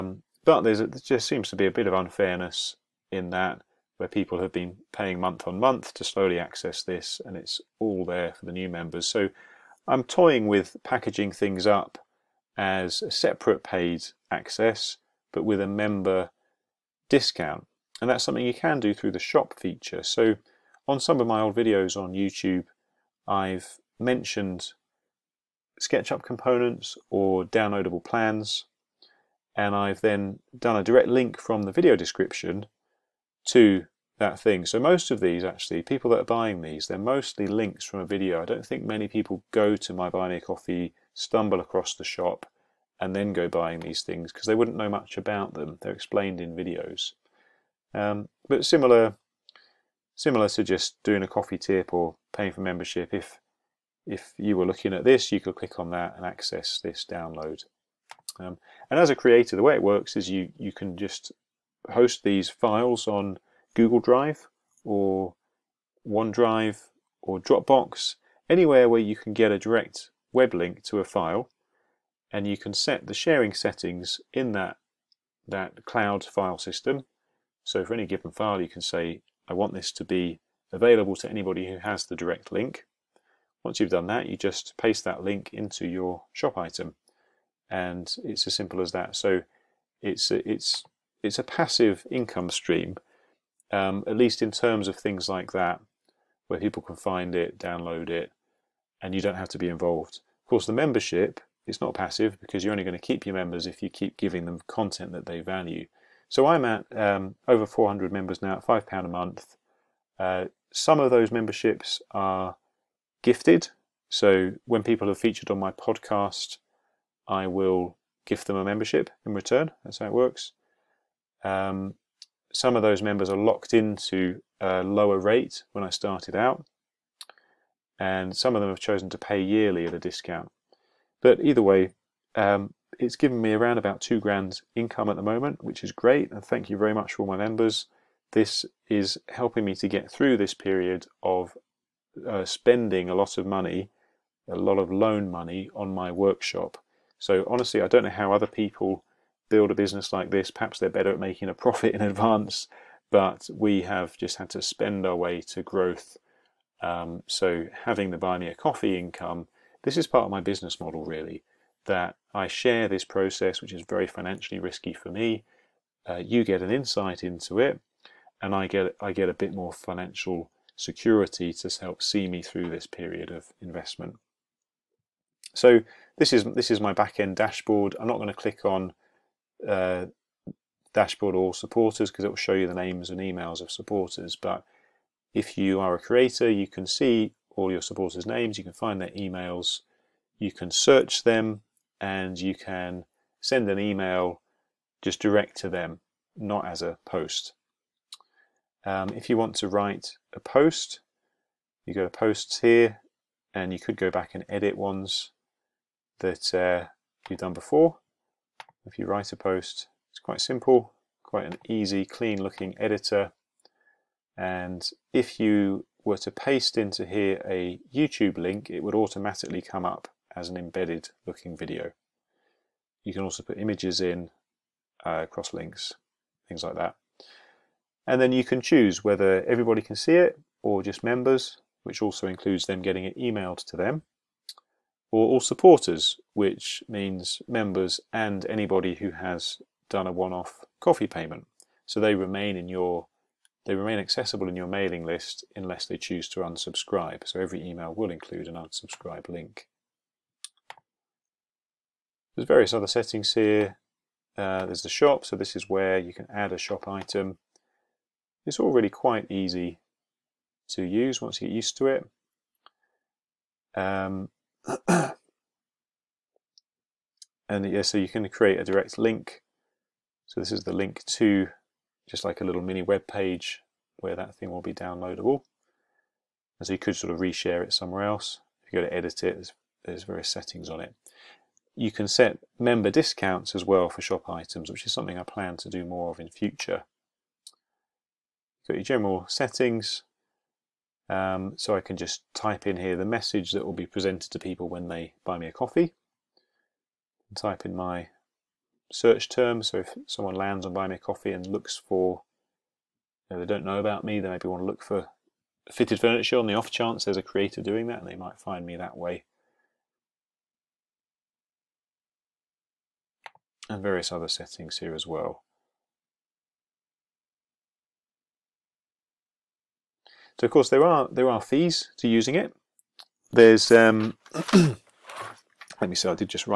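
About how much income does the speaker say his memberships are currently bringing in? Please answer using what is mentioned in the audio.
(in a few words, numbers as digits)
two grand.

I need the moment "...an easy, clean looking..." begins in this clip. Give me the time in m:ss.
3:31.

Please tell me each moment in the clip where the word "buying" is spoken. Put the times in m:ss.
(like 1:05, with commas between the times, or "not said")
0:36, 0:43.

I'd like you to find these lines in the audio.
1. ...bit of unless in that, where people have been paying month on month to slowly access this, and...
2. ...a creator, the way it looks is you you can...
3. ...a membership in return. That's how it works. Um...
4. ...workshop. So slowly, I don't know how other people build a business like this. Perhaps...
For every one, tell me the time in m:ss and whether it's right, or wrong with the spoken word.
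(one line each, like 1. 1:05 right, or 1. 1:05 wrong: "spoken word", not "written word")
1. 0:01 wrong: "unfairness", not "unless"
2. 0:59 wrong: "works", not "looks"
3. 1:58 right
4. 2:26 wrong: "honestly", not "slowly".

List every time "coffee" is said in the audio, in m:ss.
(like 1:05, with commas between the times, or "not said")
0:40, 0:51, 2:38, 4:00, 4:55, 5:00.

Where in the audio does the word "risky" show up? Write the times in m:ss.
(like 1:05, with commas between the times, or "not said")
2:44.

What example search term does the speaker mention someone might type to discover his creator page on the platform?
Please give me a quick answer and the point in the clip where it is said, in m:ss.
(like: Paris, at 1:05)
fitted furniture, at 5:05.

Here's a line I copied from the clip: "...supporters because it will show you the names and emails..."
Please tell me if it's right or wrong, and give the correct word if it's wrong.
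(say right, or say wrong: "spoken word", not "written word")
right.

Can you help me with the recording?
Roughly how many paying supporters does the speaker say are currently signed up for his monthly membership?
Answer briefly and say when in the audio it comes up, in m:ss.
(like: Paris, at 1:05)
over 400, at 1:47.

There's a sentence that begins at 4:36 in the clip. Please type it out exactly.
And so you could sort of reshare it somewhere else.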